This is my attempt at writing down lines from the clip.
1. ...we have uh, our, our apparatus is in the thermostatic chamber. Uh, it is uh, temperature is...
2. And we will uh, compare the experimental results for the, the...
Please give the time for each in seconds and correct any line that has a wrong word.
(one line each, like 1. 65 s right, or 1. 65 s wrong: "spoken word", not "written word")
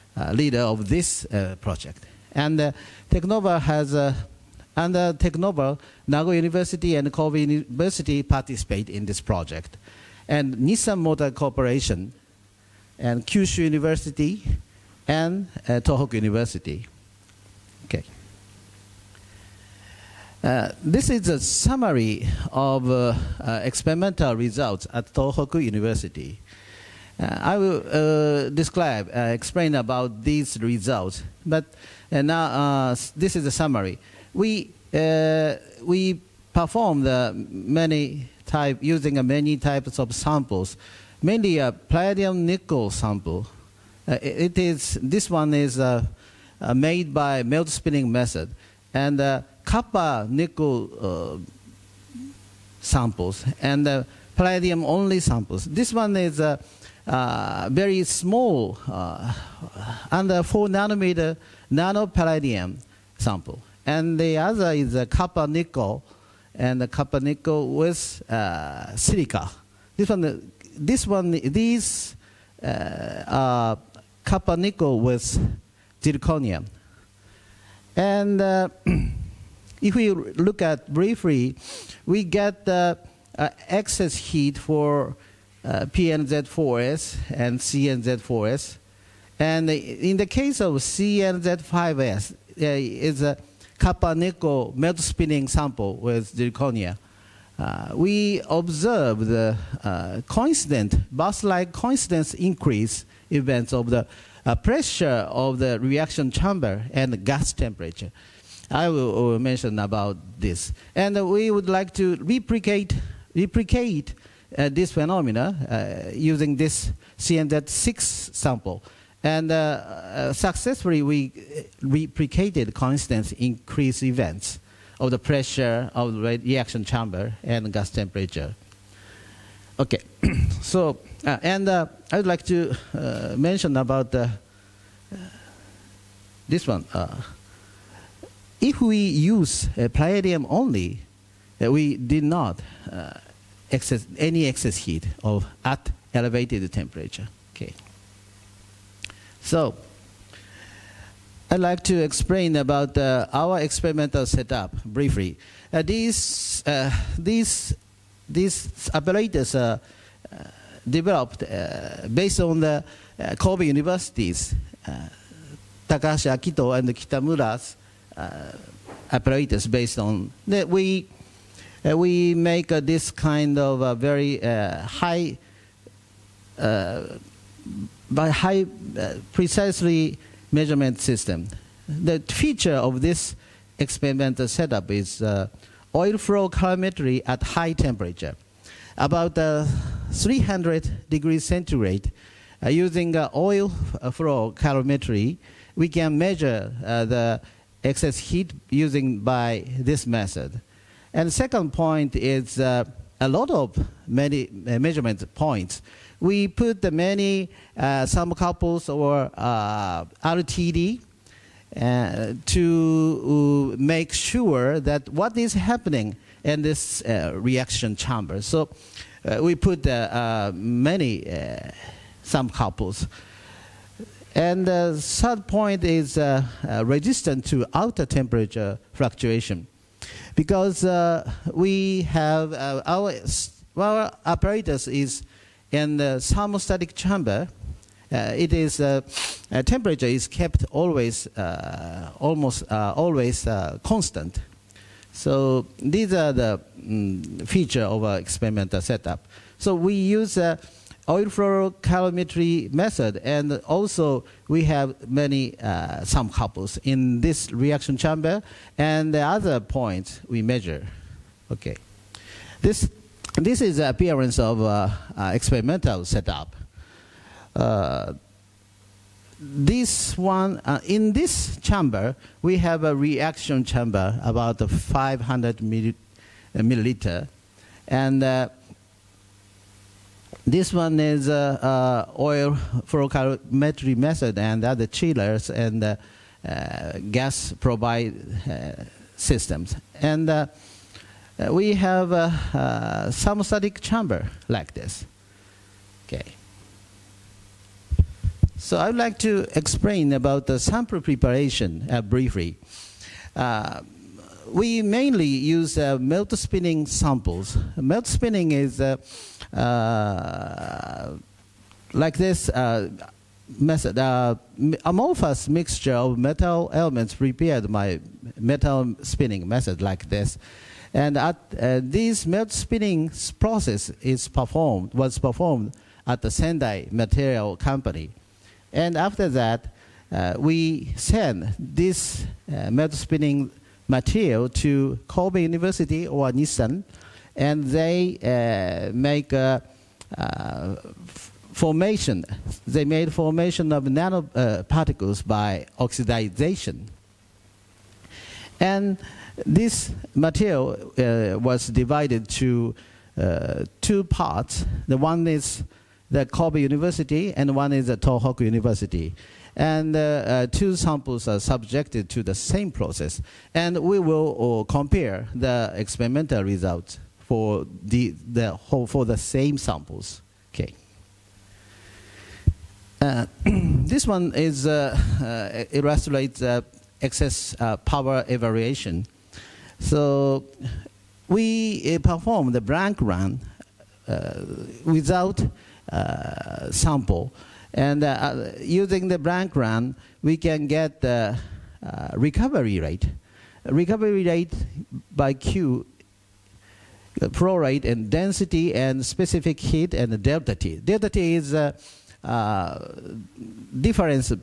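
1. 231 s right
2. 363 s right.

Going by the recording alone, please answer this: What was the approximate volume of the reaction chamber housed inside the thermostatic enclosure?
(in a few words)
500 milliliters.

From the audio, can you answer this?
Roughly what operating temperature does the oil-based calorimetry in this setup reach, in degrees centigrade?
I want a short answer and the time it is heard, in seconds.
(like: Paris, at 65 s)
300, at 190 s.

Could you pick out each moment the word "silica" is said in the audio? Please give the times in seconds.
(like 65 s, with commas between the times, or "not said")
68 s.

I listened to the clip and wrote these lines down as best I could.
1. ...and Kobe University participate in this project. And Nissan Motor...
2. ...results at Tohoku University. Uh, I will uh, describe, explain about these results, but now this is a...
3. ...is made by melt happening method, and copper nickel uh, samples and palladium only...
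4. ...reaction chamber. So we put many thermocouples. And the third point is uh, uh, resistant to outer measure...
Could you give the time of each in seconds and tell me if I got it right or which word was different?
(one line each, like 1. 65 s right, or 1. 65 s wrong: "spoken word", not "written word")
1. 6 s right
2. 24 s right
3. 45 s wrong: "spinning", not "happening"
4. 217 s wrong: "temperature", not "measure".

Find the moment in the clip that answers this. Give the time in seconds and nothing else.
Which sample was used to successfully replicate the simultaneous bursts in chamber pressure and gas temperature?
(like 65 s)
117 s.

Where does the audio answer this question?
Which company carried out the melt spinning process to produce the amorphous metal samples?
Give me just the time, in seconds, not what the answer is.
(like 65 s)
326 s.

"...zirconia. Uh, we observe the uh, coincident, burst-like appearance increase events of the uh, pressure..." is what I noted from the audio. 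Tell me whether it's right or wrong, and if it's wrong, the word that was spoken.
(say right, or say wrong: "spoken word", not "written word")
wrong: "coincidence", not "appearance".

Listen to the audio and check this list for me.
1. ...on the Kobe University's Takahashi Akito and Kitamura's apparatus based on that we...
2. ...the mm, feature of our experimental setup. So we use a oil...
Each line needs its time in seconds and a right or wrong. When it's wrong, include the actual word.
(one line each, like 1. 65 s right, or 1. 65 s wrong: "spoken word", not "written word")
1. 162 s right
2. 246 s right.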